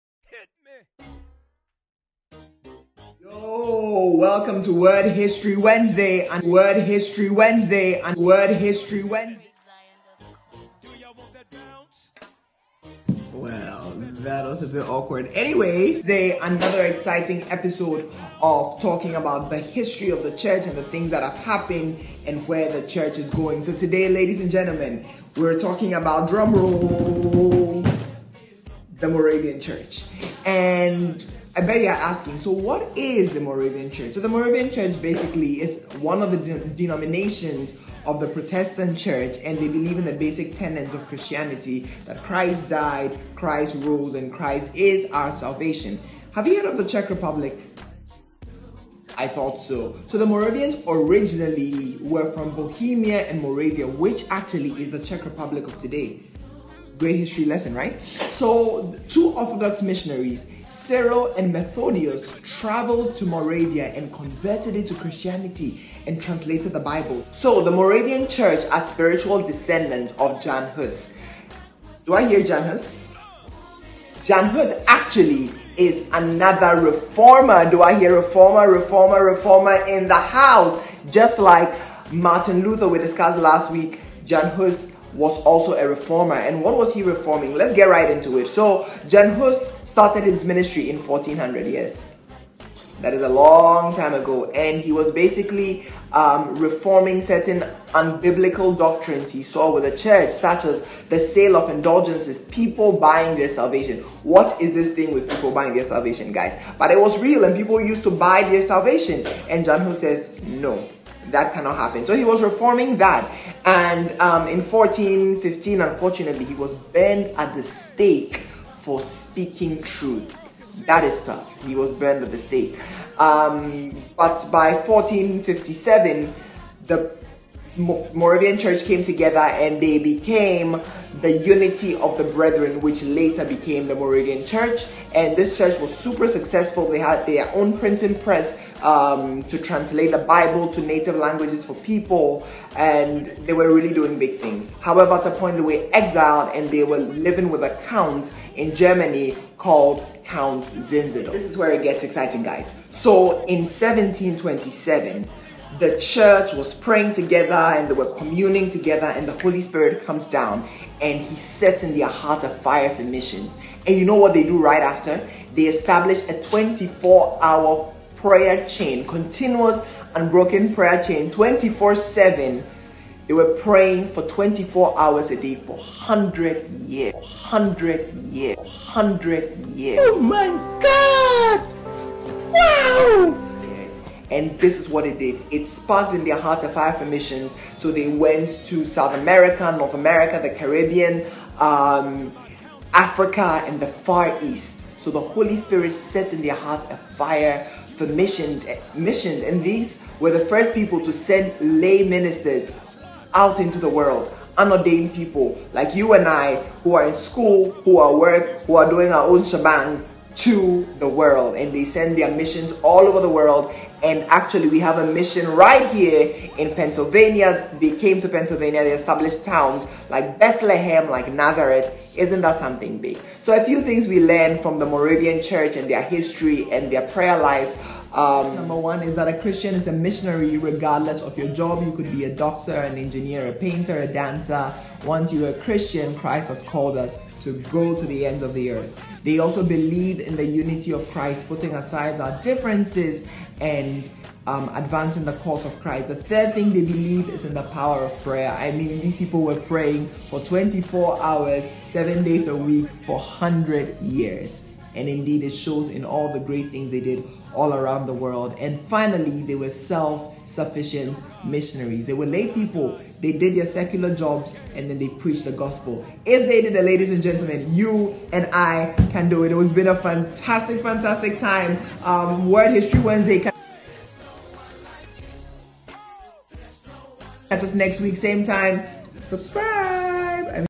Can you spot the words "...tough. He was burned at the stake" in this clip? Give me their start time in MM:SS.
02:01.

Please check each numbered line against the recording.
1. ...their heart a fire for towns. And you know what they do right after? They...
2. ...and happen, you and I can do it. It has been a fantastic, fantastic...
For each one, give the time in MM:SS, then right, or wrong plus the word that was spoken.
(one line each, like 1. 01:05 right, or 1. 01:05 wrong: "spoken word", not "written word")
1. 02:41 wrong: "missions", not "towns"
2. 04:27 wrong: "gentlemen", not "happen".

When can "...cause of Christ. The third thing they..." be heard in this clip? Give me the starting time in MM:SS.
04:05.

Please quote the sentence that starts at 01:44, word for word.
What is this thing with people buying their salvation, guys?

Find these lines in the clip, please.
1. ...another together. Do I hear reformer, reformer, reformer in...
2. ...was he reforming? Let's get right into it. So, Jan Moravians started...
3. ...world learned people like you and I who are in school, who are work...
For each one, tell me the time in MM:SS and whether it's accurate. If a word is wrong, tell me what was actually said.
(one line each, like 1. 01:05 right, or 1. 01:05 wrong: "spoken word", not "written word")
1. 01:16 wrong: "reformer", not "together"
2. 01:26 wrong: "Hus", not "Moravians"
3. 03:23 wrong: "unordained", not "learned".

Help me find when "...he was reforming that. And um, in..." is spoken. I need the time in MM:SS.
01:52.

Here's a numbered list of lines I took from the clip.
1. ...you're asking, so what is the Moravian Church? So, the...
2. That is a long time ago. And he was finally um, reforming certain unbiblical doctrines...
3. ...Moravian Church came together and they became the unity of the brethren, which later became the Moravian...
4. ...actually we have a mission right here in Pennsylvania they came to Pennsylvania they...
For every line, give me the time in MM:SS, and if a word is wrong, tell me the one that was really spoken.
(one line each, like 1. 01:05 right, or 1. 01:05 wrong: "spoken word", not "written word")
1. 00:31 right
2. 01:33 wrong: "basically", not "finally"
3. 02:07 right
4. 03:34 right.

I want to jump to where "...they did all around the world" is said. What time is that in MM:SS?
04:16.